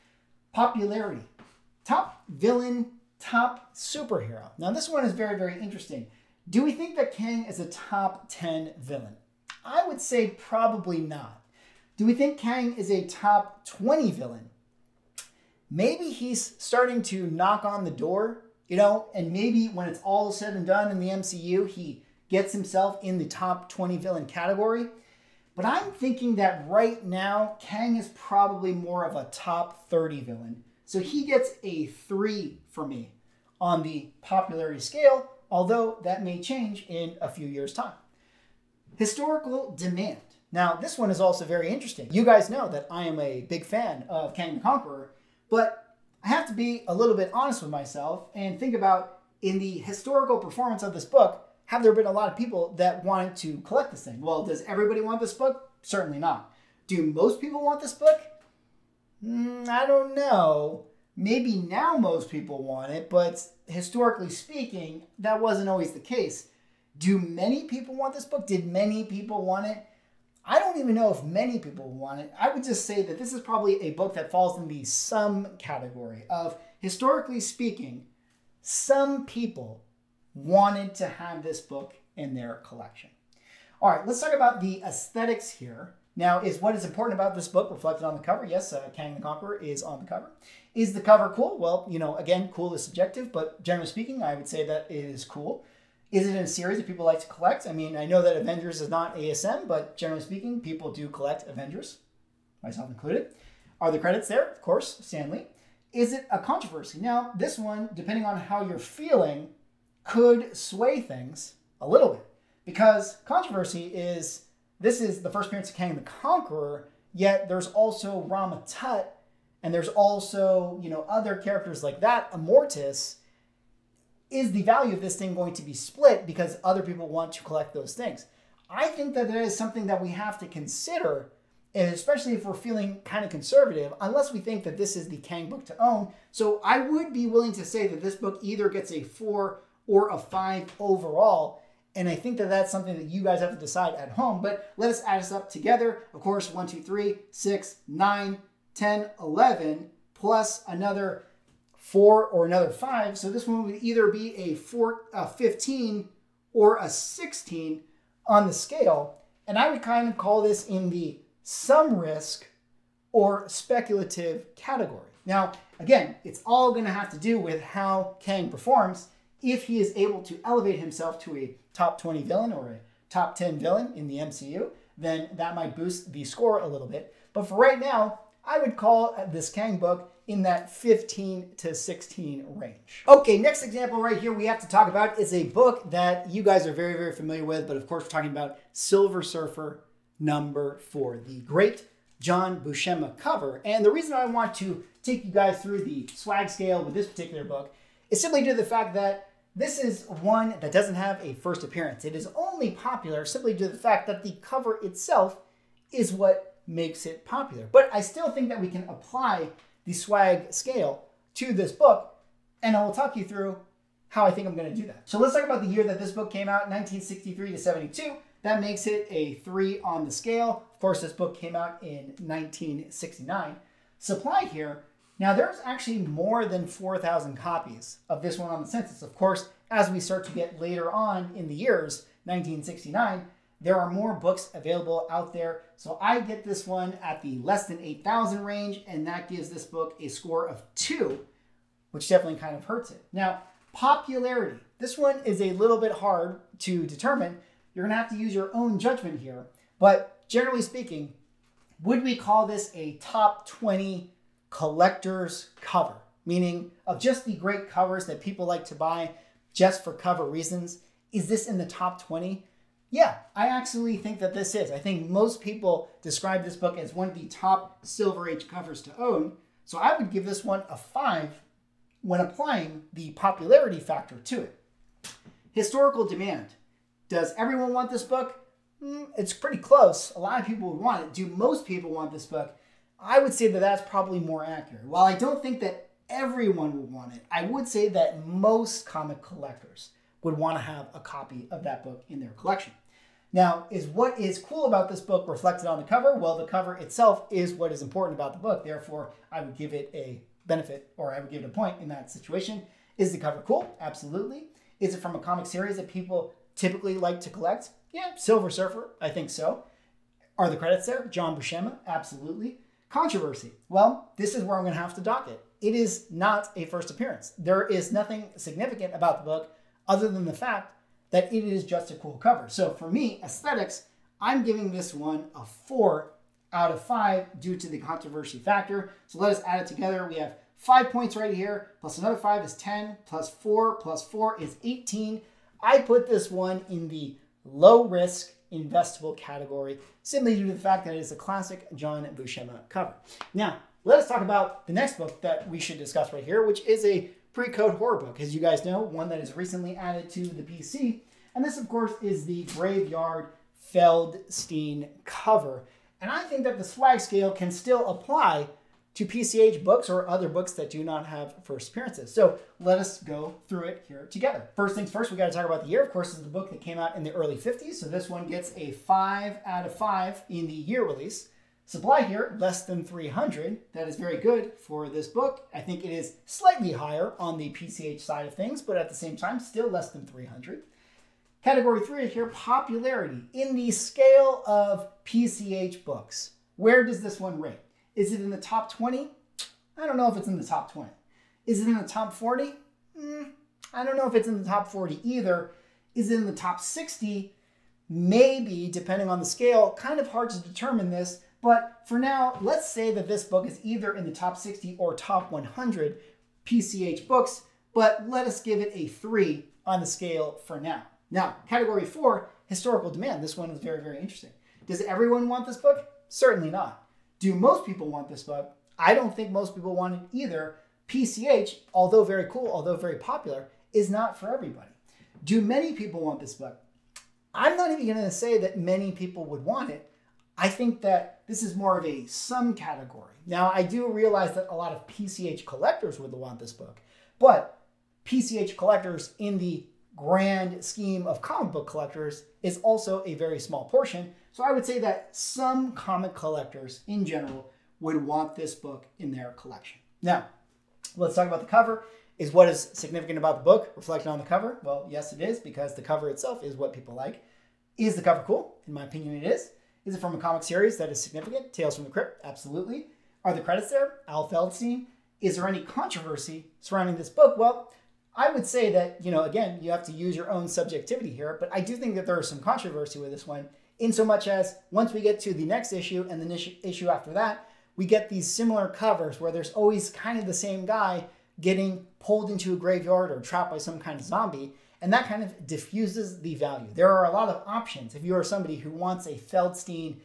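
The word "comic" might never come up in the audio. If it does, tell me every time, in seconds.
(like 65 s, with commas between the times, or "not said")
288 s, 305 s, 441 s, 445 s, 460 s.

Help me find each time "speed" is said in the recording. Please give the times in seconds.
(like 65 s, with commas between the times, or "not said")
not said.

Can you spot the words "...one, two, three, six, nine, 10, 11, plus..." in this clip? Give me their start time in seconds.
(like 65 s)
146 s.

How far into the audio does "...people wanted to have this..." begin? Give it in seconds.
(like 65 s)
79 s.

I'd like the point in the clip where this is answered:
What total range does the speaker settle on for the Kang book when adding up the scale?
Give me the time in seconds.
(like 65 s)
180 s.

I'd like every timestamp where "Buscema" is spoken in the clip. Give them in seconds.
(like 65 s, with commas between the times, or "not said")
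192 s, 311 s, 342 s.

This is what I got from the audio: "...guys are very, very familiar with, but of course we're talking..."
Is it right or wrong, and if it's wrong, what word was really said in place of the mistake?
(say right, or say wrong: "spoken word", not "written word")
right.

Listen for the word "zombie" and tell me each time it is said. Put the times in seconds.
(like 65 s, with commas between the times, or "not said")
484 s.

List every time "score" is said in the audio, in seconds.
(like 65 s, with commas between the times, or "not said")
176 s, 240 s.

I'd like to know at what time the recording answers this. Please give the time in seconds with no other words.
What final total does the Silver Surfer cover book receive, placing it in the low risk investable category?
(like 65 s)
334 s.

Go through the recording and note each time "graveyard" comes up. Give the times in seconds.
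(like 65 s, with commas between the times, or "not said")
352 s, 482 s.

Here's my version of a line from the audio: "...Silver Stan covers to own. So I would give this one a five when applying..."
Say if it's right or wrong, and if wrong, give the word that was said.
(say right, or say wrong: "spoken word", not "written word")
wrong: "Age", not "Stan".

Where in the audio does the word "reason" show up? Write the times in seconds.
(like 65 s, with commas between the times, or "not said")
193 s, 260 s.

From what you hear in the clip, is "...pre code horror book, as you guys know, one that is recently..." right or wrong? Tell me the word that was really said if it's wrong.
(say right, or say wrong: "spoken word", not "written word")
right.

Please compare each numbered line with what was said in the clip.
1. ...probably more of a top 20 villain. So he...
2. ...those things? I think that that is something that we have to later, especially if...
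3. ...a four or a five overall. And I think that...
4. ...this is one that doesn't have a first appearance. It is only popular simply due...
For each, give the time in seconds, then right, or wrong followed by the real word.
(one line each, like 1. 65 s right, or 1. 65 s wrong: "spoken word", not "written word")
1. 28 s wrong: "30", not "20"
2. 127 s wrong: "consider", not "later"
3. 138 s right
4. 199 s right.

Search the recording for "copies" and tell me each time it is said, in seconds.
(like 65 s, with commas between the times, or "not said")
227 s.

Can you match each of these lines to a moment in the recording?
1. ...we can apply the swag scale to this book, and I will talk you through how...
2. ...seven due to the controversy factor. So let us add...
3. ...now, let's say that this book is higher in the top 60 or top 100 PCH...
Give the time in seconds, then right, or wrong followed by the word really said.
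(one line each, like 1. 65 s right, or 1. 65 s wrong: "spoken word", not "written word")
1. 208 s right
2. 326 s wrong: "five", not "seven"
3. 401 s wrong: "either", not "higher".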